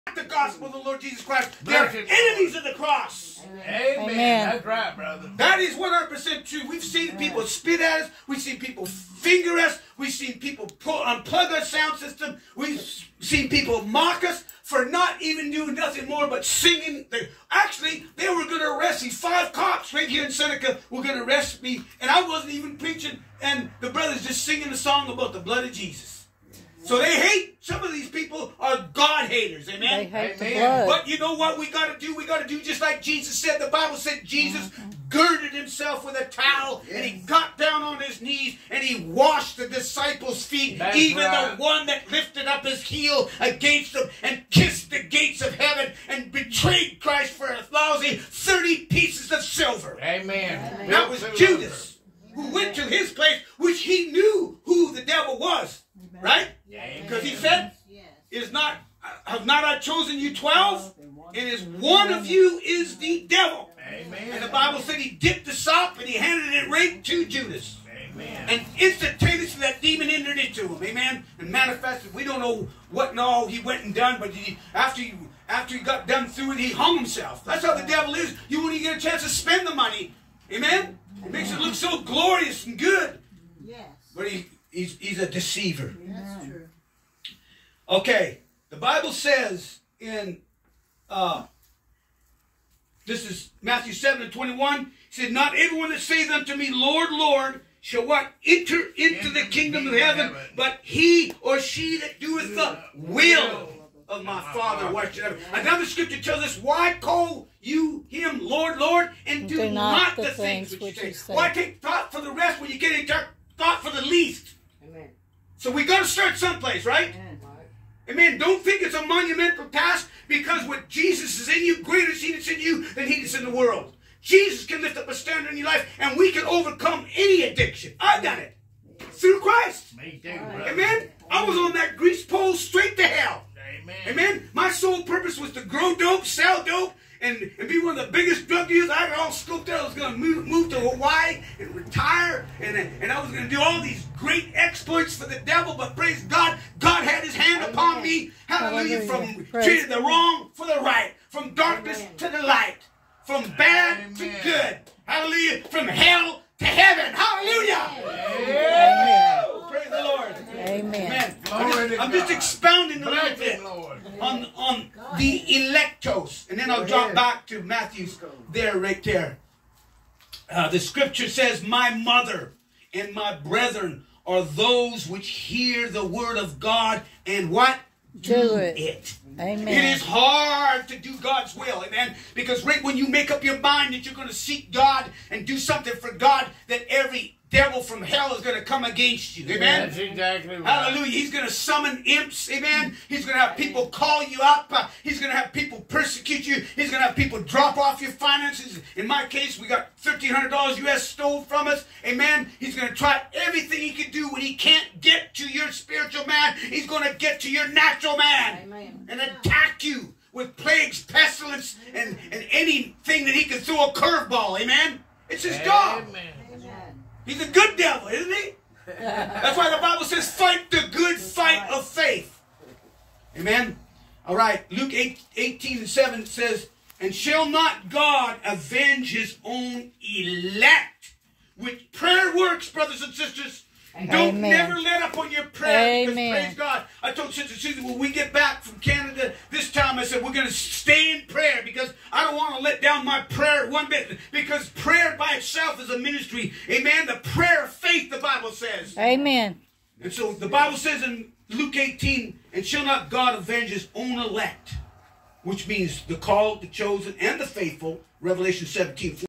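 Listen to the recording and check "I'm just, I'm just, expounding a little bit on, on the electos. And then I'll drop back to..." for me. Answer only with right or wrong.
right.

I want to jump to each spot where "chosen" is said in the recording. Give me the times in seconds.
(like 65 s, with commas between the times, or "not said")
59 s, 256 s.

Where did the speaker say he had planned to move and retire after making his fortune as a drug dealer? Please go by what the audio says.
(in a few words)
Hawaii.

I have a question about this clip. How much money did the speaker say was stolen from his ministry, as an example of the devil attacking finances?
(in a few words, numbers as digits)
$1,300 US.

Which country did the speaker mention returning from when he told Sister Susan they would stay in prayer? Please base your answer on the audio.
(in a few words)
Canada.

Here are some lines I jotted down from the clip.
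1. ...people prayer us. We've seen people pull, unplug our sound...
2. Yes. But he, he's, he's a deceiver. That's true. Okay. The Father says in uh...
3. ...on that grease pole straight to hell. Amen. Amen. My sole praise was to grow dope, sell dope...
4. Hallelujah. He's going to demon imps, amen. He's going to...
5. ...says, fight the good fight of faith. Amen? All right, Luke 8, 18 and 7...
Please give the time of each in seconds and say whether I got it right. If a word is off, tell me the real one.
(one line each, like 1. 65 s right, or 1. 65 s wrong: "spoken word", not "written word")
1. 8 s wrong: "finger", not "prayer"
2. 83 s wrong: "Bible", not "Father"
3. 131 s wrong: "purpose", not "praise"
4. 190 s wrong: "summon", not "demon"
5. 220 s right.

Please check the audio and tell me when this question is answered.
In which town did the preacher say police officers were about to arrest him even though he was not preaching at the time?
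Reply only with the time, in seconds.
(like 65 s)
20 s.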